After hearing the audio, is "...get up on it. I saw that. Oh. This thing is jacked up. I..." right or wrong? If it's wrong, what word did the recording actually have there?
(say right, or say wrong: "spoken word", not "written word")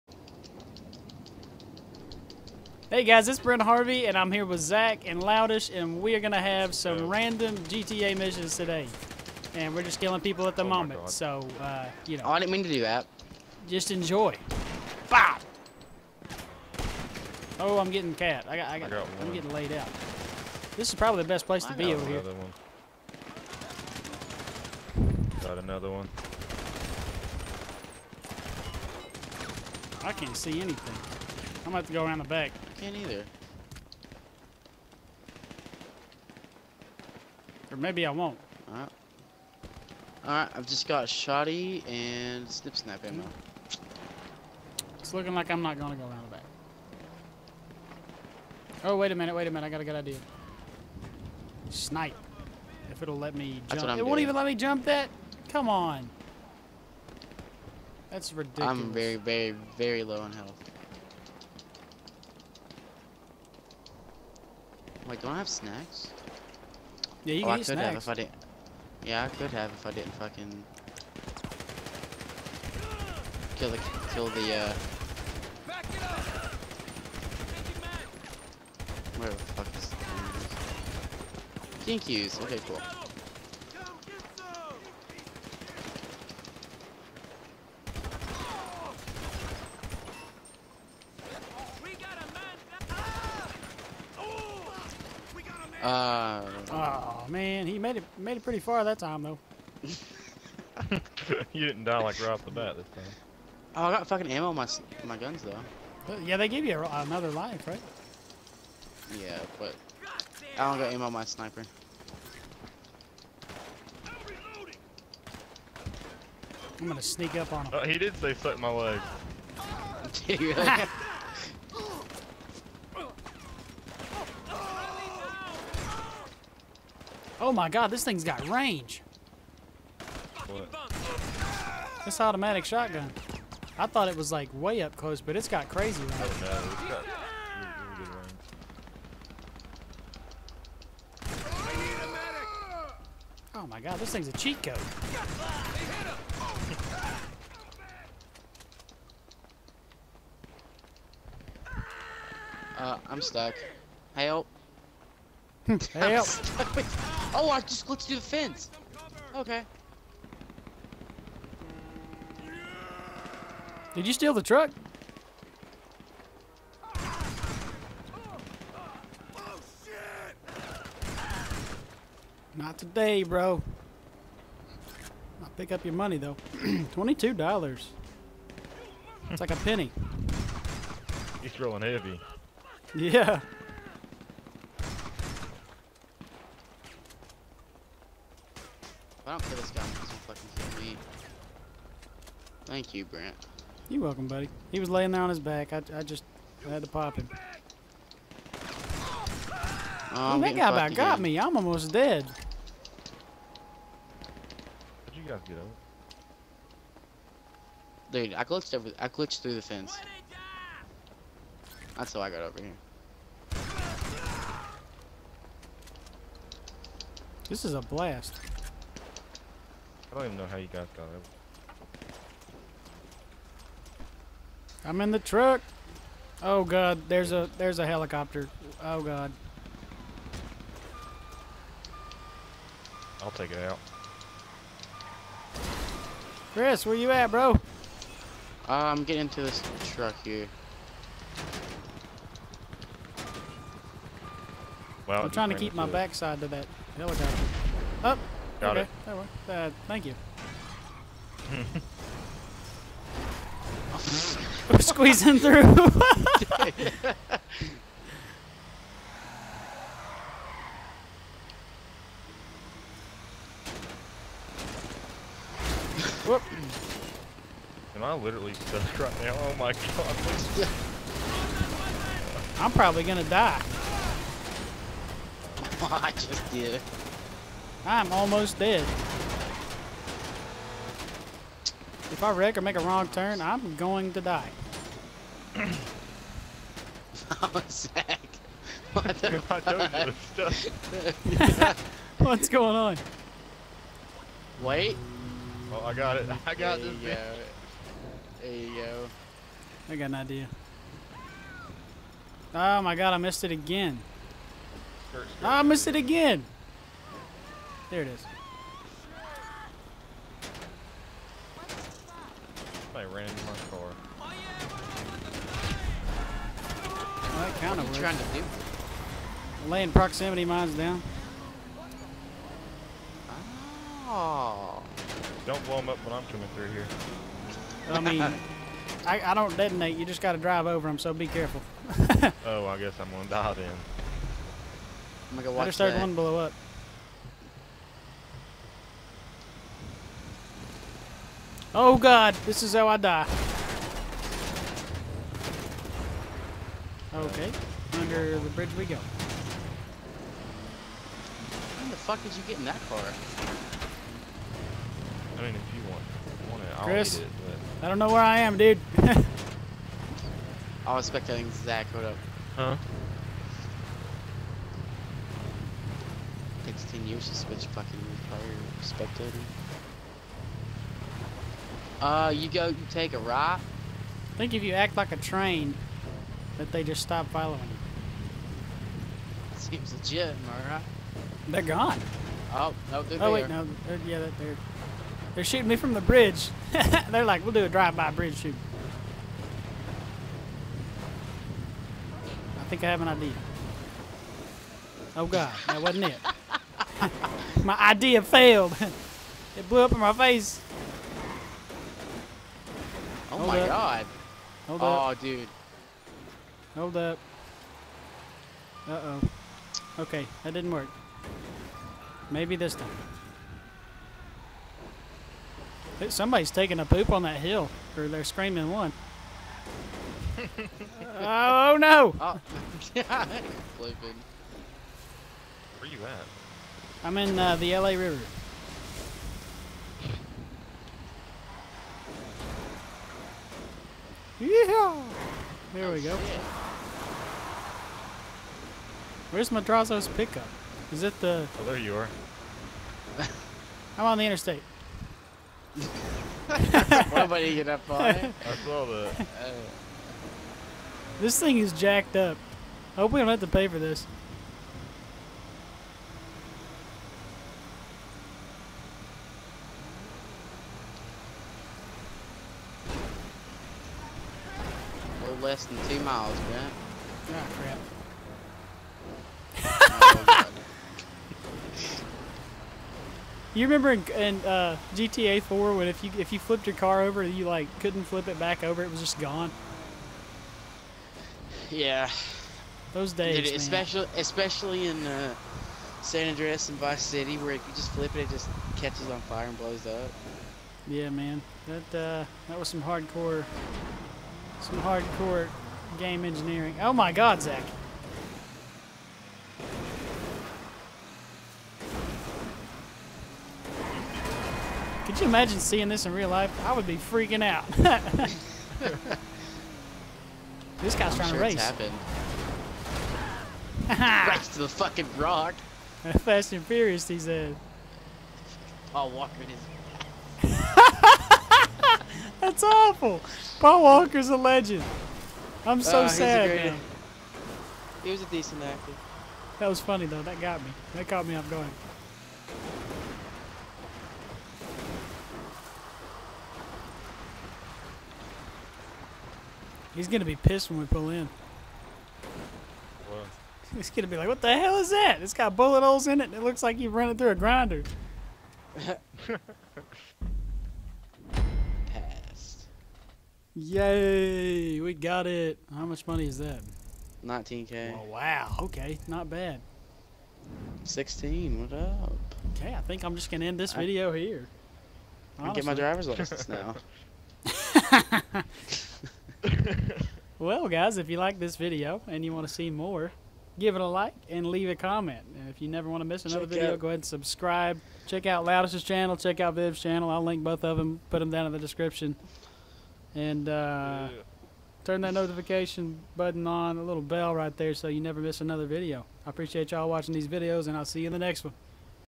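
right.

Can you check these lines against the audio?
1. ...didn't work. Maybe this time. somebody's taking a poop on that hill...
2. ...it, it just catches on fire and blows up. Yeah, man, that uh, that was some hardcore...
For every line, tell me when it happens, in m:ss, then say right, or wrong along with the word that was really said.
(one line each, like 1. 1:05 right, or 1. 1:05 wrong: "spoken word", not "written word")
1. 6:50 right
2. 8:08 right.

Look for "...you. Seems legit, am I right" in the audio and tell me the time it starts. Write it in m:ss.
6:17.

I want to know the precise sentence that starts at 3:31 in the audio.
That's how I got over here.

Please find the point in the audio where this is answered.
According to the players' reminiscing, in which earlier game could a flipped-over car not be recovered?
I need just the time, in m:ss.
7:54.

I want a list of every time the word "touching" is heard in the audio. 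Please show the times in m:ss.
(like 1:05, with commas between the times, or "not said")
not said.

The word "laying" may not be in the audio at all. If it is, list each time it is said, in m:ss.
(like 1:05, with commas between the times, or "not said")
3:14, 5:19.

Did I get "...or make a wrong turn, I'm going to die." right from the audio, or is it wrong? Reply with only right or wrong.
right.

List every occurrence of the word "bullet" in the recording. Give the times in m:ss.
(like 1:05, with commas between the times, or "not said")
9:05.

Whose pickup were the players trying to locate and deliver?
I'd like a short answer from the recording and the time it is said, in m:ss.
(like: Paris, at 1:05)
Madrazo, at 7:19.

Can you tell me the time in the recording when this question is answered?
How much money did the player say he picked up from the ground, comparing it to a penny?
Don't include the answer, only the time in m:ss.
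2:56.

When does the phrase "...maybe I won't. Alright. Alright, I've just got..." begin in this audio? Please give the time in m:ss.
0:37.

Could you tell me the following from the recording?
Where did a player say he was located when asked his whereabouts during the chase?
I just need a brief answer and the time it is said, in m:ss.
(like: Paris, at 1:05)
LA River, at 7:07.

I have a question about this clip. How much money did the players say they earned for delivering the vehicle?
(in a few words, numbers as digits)
19k.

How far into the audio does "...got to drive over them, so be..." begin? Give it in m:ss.
5:30.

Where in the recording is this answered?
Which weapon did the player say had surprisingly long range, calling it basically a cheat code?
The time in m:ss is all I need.
2:12.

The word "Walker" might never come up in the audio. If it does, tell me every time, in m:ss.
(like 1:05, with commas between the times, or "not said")
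8:39, 8:43.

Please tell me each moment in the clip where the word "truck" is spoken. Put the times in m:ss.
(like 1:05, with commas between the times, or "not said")
2:44, 3:45, 3:59.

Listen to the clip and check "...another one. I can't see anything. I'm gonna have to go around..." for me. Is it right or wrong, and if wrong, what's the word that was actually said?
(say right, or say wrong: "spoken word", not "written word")
right.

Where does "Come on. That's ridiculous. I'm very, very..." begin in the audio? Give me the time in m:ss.
0:55.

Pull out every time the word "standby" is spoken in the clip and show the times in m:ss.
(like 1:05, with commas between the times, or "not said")
not said.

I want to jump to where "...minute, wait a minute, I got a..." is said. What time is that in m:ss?
0:49.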